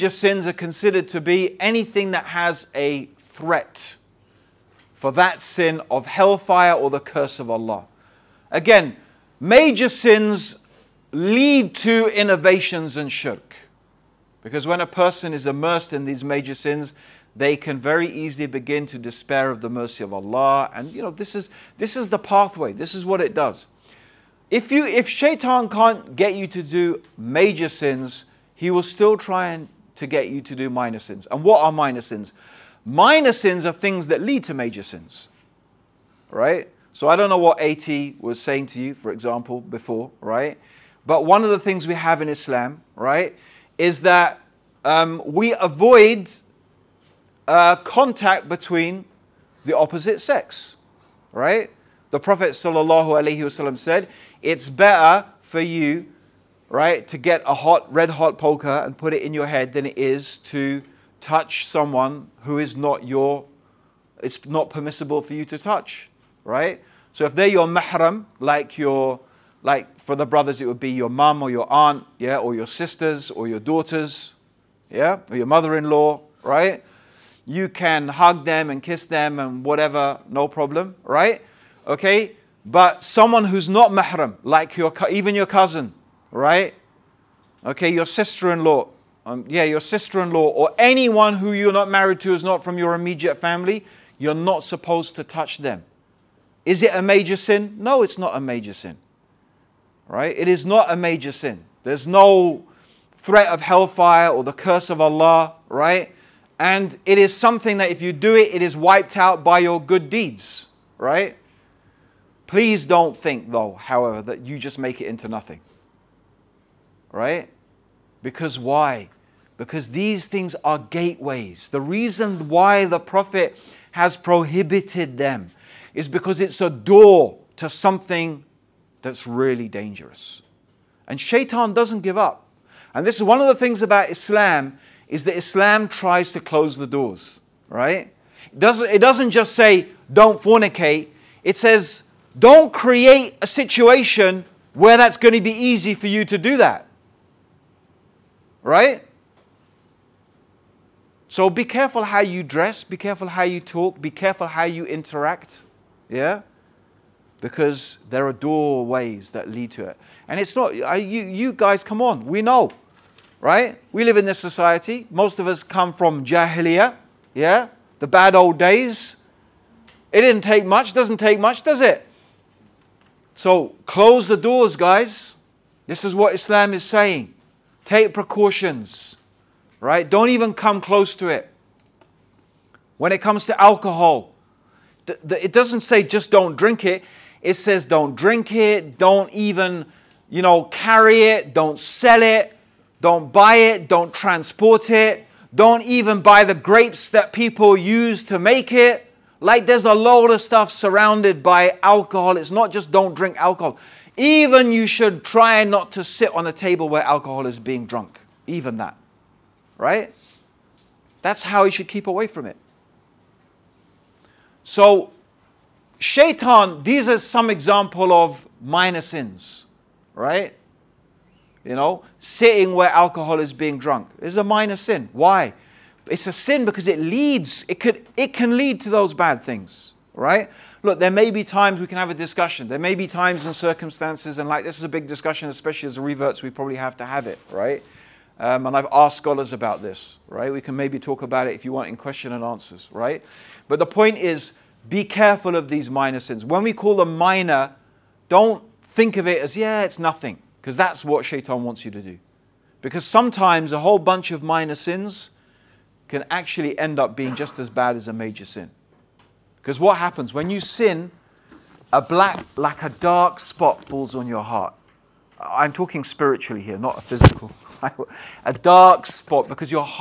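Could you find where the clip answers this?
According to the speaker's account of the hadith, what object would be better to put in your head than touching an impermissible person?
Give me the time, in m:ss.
0:57.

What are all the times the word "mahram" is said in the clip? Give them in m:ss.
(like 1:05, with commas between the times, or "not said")
1:07, 1:23.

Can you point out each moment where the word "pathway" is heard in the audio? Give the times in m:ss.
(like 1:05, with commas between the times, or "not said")
0:22.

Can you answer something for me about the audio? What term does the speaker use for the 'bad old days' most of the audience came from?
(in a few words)
Jahiliya.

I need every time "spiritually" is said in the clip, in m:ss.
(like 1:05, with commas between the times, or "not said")
4:26.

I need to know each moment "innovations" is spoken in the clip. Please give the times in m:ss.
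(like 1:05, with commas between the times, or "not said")
0:12.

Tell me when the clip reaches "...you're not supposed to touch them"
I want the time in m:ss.
1:34.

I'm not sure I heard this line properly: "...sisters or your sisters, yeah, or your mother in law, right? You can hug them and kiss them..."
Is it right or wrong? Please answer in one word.
wrong.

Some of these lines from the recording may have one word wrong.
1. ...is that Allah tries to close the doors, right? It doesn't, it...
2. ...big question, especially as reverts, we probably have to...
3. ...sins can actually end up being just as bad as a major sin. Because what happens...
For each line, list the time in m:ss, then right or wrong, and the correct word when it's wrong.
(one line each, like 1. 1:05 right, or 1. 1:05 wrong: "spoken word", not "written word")
1. 2:15 wrong: "Islam", not "Allah"
2. 3:54 wrong: "discussion", not "question"
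3. 4:14 right.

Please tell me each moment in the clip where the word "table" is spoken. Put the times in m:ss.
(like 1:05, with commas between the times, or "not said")
3:26.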